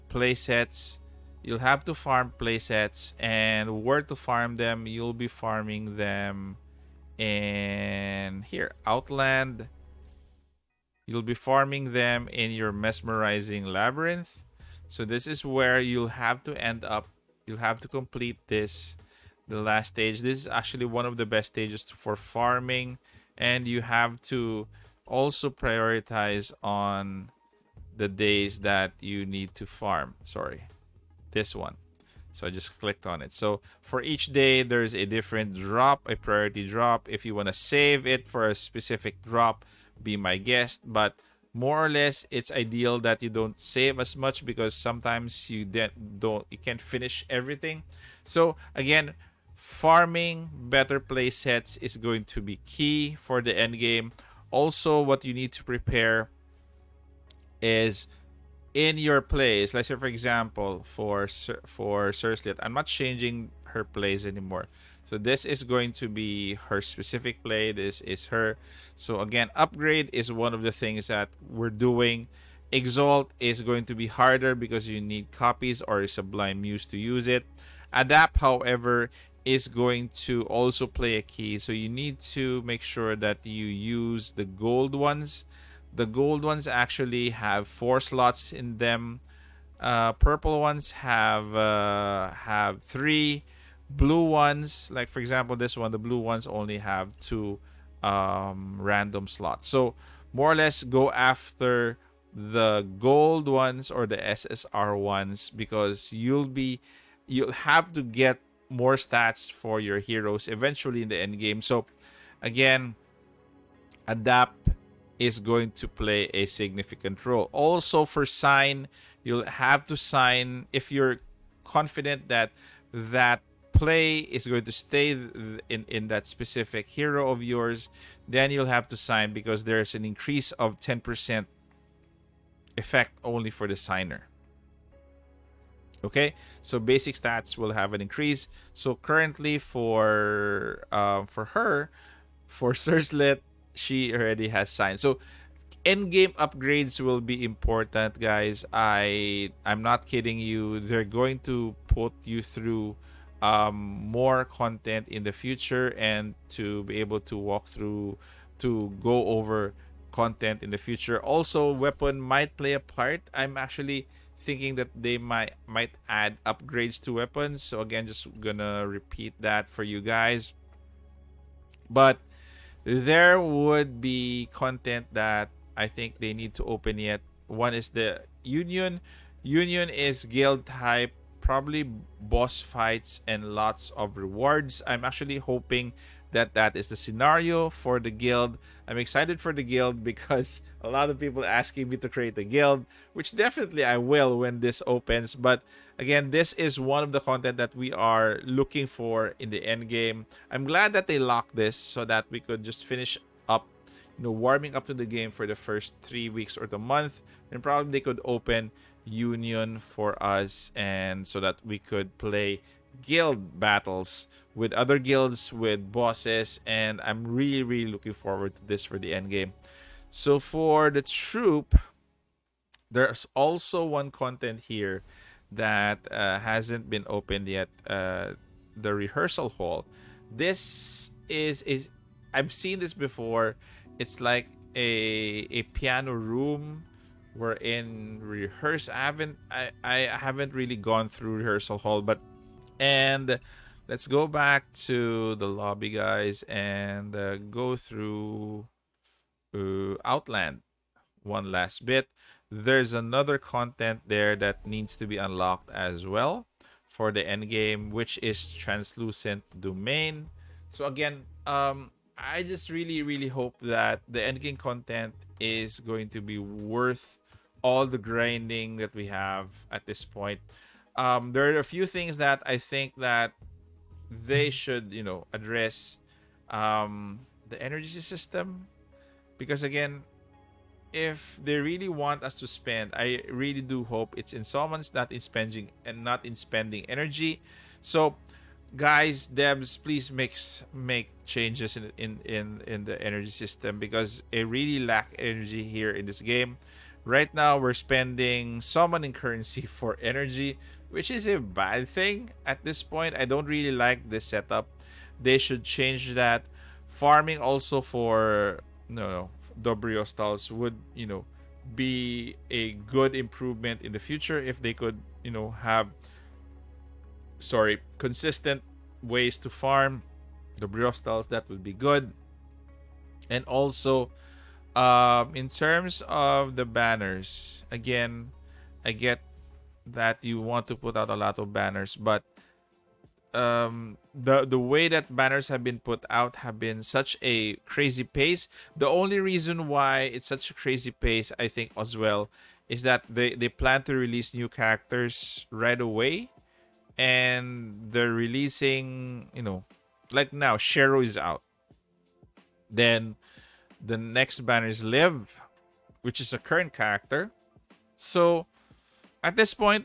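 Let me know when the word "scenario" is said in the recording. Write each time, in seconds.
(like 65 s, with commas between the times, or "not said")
186 s.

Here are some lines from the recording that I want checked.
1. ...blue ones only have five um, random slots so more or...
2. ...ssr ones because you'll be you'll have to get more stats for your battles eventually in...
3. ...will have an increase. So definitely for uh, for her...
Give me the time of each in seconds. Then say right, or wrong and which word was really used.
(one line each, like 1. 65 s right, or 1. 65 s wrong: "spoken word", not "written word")
1. 95 s wrong: "two", not "five"
2. 104 s wrong: "heroes", not "battles"
3. 137 s wrong: "currently", not "definitely".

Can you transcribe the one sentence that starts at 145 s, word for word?
So end game upgrades will be important, guys.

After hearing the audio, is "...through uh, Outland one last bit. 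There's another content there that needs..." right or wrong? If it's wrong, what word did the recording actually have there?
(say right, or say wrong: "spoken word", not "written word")
right.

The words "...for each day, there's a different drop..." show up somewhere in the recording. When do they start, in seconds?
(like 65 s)
33 s.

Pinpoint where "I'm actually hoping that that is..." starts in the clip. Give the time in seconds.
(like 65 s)
184 s.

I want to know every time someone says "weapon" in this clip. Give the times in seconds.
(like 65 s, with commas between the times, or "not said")
161 s, 167 s.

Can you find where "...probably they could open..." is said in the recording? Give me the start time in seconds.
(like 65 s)
207 s.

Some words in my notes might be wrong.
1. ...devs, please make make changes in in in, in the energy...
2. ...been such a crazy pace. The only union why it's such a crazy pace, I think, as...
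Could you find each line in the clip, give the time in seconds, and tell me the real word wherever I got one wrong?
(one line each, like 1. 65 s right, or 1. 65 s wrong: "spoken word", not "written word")
1. 289 s right
2. 336 s wrong: "reason", not "union".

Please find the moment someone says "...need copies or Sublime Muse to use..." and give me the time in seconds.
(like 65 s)
75 s.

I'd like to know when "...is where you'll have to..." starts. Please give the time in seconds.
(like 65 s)
15 s.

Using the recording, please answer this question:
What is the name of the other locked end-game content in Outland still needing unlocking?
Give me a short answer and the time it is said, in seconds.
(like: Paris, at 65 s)
Translucent Domain, at 258 s.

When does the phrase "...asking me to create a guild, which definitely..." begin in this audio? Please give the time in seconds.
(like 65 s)
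191 s.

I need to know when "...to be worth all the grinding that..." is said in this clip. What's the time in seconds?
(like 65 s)
266 s.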